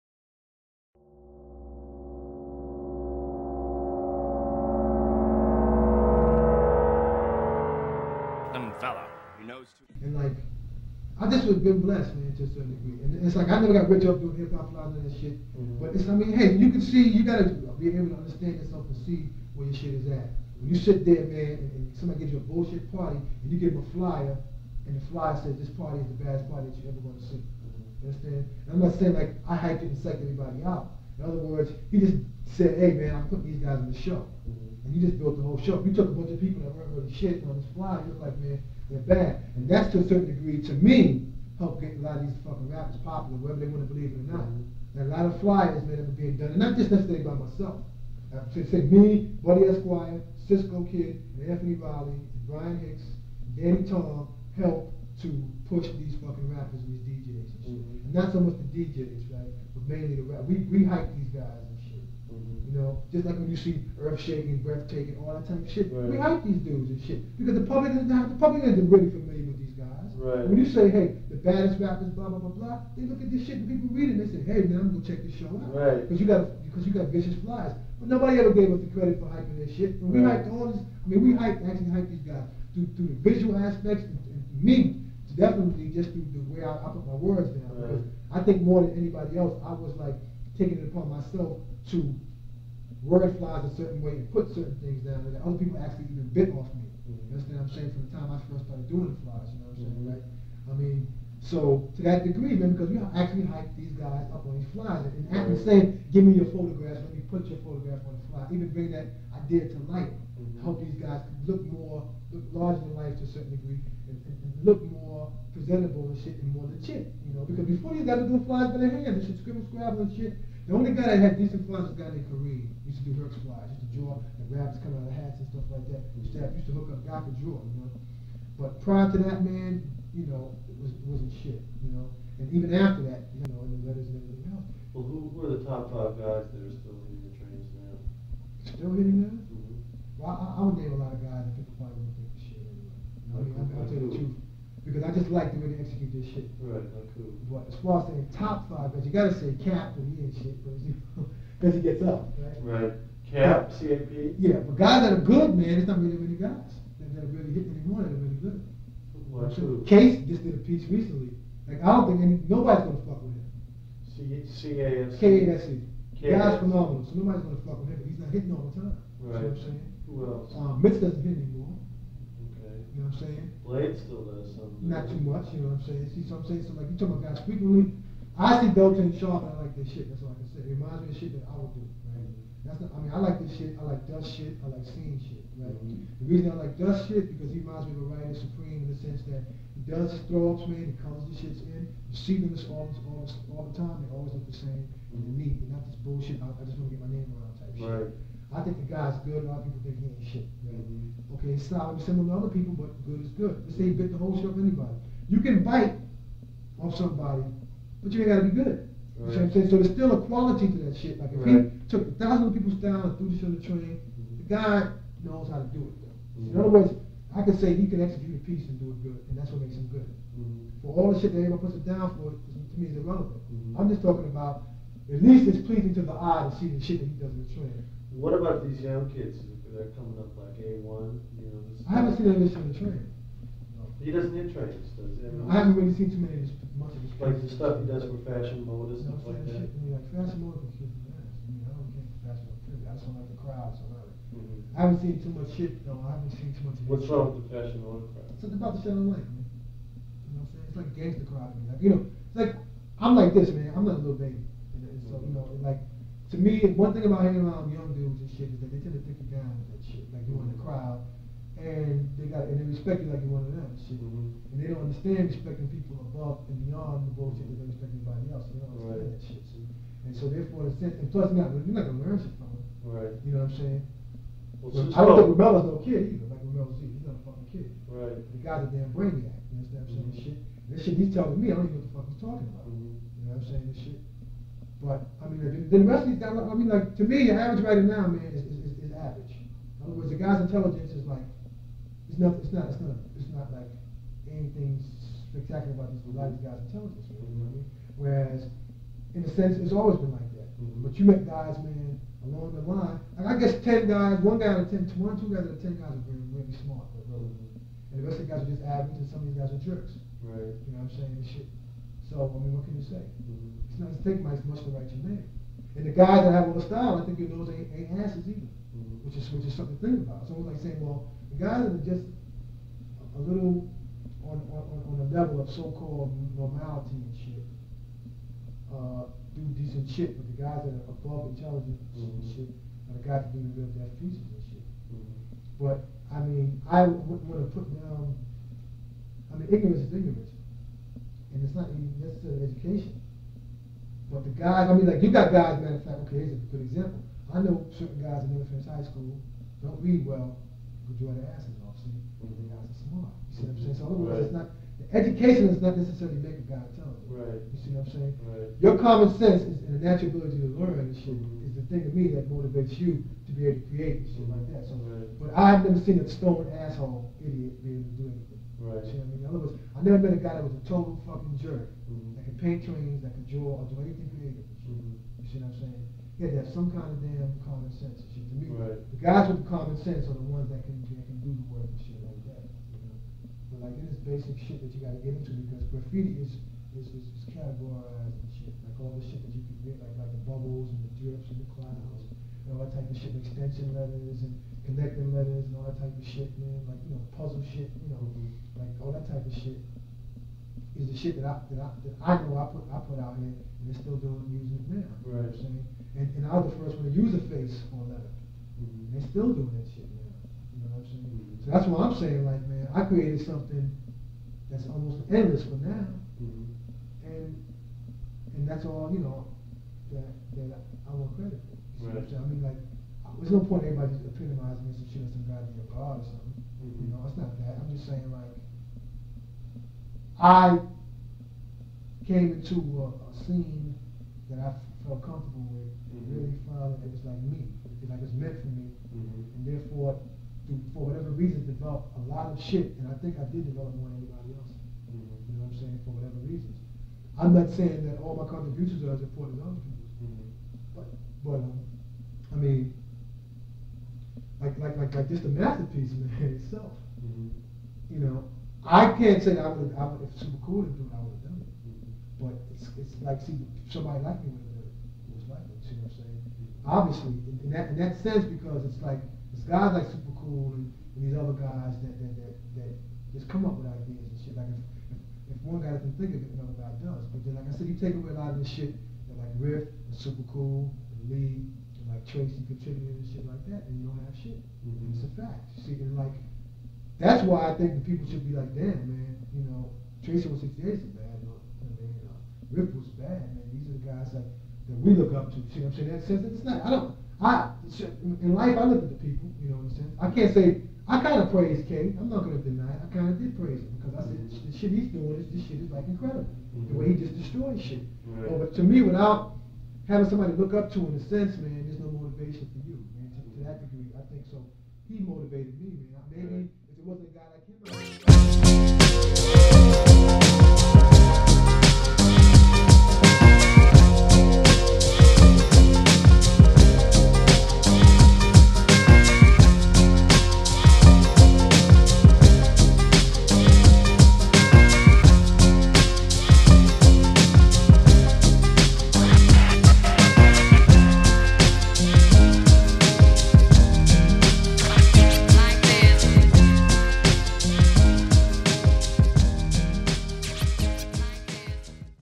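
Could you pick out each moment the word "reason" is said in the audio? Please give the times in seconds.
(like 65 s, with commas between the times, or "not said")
186 s, 441 s, 446 s.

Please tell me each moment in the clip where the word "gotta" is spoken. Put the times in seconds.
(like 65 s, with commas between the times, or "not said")
17 s, 149 s, 208 s, 384 s.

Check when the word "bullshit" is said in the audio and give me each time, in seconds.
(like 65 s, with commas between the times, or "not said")
22 s, 196 s, 267 s.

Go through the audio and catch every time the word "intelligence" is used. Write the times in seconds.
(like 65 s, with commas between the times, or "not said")
290 s, 296 s, 331 s.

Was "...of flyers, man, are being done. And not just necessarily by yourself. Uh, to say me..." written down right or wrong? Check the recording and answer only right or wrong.
wrong.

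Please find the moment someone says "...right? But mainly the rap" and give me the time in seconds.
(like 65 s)
59 s.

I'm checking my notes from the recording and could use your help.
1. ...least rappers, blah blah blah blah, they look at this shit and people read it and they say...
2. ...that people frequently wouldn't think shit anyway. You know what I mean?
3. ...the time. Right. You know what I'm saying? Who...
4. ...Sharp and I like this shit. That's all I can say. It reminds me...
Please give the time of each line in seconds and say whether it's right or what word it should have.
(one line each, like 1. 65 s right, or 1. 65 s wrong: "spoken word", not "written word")
1. 71 s wrong: "baddest", not "least"
2. 141 s wrong: "probably", not "frequently"
3. 168 s right
4. 179 s right.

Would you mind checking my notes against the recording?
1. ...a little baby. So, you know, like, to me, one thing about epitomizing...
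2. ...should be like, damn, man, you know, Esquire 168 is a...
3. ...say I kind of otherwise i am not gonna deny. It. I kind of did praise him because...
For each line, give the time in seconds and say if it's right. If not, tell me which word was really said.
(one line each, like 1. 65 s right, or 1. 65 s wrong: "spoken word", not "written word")
1. 253 s wrong: "hanging", not "epitomizing"
2. 488 s wrong: "Tracy", not "Esquire"
3. 500 s wrong: "praise", not "otherwise".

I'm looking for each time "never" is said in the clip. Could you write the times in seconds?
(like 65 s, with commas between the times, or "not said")
13 s, 348 s, 365 s, 369 s.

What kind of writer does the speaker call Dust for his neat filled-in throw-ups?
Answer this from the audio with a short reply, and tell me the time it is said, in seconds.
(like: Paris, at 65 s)
writer supreme, at 188 s.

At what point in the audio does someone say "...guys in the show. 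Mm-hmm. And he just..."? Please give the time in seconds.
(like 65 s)
33 s.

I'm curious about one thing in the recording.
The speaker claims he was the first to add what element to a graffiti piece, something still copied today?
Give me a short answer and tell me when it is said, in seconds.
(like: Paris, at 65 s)
a face, at 407 s.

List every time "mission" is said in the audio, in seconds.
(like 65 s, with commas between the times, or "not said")
not said.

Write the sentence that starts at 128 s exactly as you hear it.
But prior to that, man, you know, it was wasn't shit, you know.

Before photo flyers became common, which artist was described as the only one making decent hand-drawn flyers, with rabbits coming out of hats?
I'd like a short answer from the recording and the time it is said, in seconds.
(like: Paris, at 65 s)
Kareem, at 122 s.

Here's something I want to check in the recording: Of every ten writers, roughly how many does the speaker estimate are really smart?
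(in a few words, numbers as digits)
1 or 2.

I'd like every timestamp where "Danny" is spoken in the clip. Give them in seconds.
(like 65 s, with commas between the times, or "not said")
53 s.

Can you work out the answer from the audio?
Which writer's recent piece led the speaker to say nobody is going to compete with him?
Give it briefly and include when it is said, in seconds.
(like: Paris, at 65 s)
Case, at 159 s.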